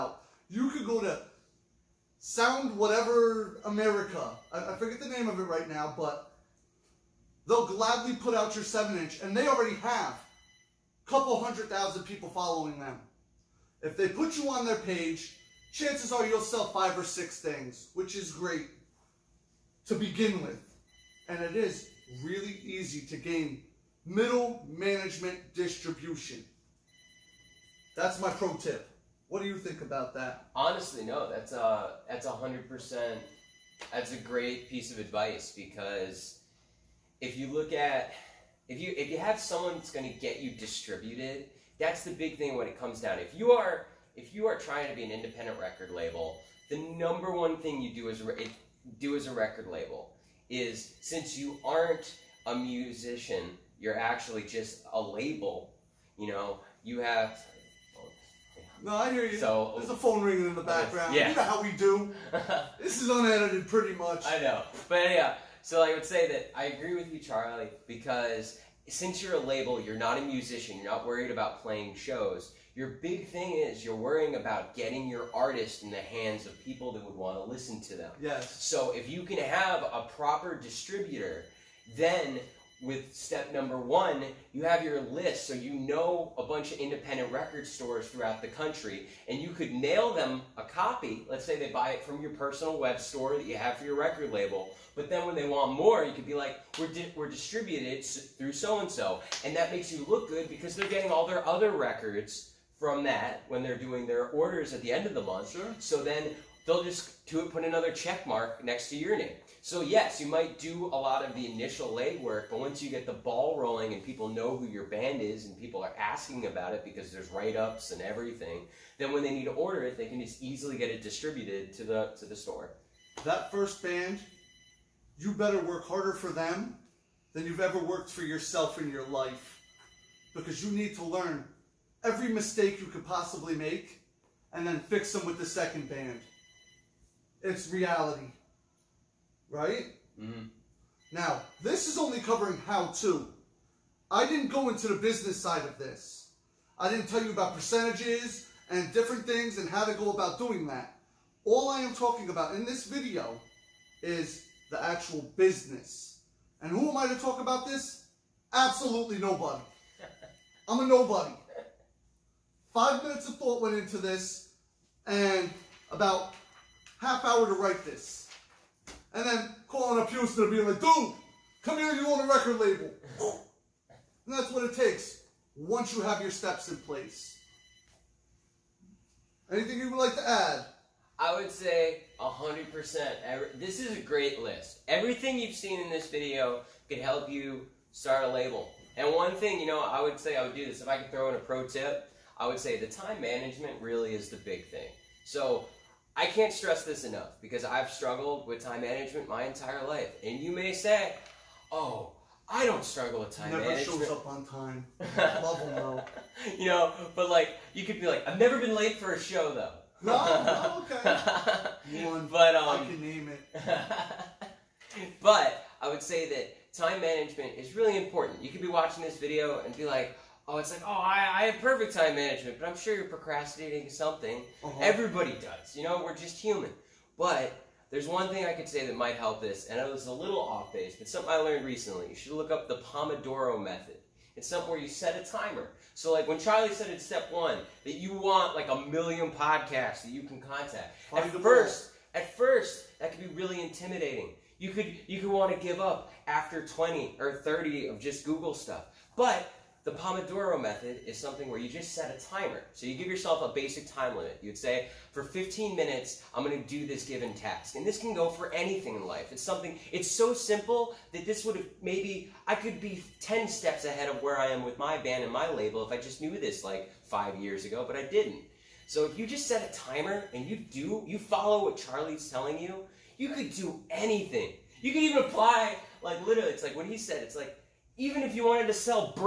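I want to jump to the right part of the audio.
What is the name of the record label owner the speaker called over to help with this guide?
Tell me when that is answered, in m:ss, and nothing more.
2:50.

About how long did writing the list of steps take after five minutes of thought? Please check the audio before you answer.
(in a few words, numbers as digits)
half hour.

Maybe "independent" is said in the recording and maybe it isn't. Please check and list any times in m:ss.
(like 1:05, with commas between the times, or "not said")
0:45, 1:26.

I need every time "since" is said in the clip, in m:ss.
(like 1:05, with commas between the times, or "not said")
0:51, 1:08.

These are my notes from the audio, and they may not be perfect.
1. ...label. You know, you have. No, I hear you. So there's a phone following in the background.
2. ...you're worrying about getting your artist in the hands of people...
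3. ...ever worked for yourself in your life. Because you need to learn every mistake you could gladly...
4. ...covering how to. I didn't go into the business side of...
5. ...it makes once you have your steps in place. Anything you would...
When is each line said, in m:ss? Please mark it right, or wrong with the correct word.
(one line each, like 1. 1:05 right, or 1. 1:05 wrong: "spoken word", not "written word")
1. 0:55 wrong: "ringing", not "following"
2. 1:13 right
3. 2:07 wrong: "possibly", not "gladly"
4. 2:22 right
5. 2:54 wrong: "takes", not "makes".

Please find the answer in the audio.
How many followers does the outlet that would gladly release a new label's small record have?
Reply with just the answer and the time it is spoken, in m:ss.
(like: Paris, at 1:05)
a couple hundred thousand, at 0:10.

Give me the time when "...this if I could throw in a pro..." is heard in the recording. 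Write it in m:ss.
3:10.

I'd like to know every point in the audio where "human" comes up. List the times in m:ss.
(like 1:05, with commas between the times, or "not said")
3:46.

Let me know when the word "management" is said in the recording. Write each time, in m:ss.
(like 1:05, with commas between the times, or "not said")
0:24, 3:13, 3:18, 3:23, 3:37, 3:42.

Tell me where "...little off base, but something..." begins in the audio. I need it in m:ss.
3:50.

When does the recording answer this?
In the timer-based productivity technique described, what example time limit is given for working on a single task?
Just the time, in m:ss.
4:15.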